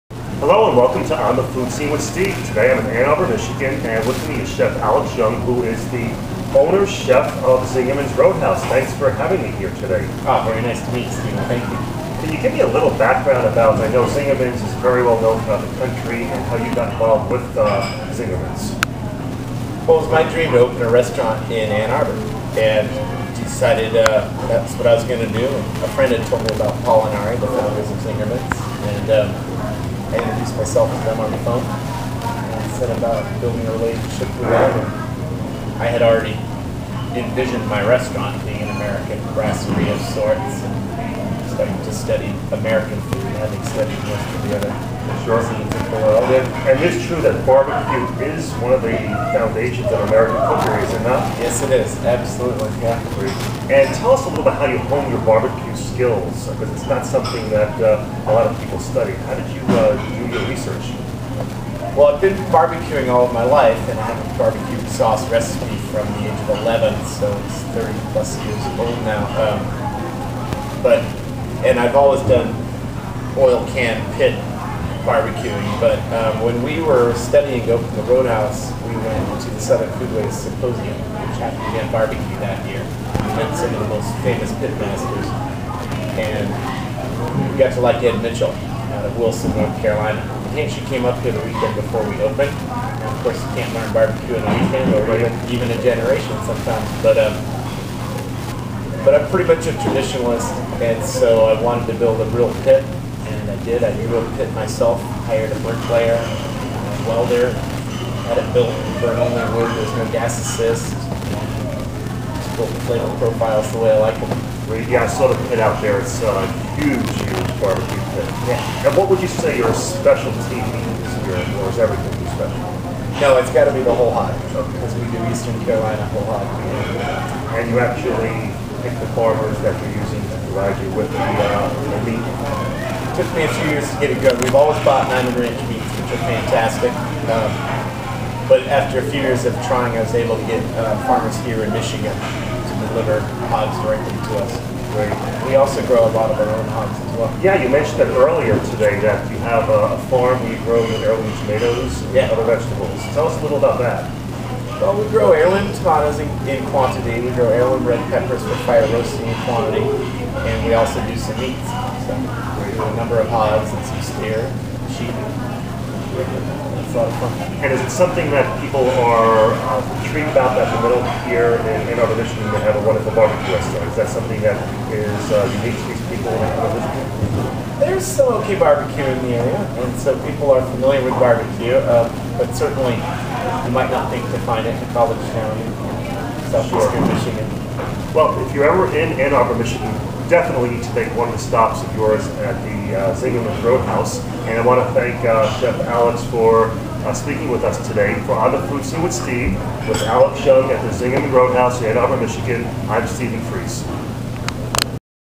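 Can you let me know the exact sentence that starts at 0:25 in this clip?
A friend had told me about Paul and Ari, the founders of Zingerman's, and.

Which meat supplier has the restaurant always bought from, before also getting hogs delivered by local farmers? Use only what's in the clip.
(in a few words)
Niman Ranch.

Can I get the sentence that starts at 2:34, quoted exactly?
Well, we grow heirloom tomatoes in, in, quantity.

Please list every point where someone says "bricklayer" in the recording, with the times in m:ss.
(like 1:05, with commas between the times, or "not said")
1:45.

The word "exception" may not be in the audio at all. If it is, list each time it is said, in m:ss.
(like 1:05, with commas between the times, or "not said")
not said.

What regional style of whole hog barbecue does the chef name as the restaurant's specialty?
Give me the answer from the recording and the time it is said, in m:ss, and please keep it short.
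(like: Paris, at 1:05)
Eastern Carolina, at 2:05.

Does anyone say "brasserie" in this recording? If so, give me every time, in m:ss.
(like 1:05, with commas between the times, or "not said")
0:39.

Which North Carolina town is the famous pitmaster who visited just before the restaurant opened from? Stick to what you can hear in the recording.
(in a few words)
Wilson, North Carolina.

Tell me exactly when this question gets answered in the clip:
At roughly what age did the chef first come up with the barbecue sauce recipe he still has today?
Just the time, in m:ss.
1:06.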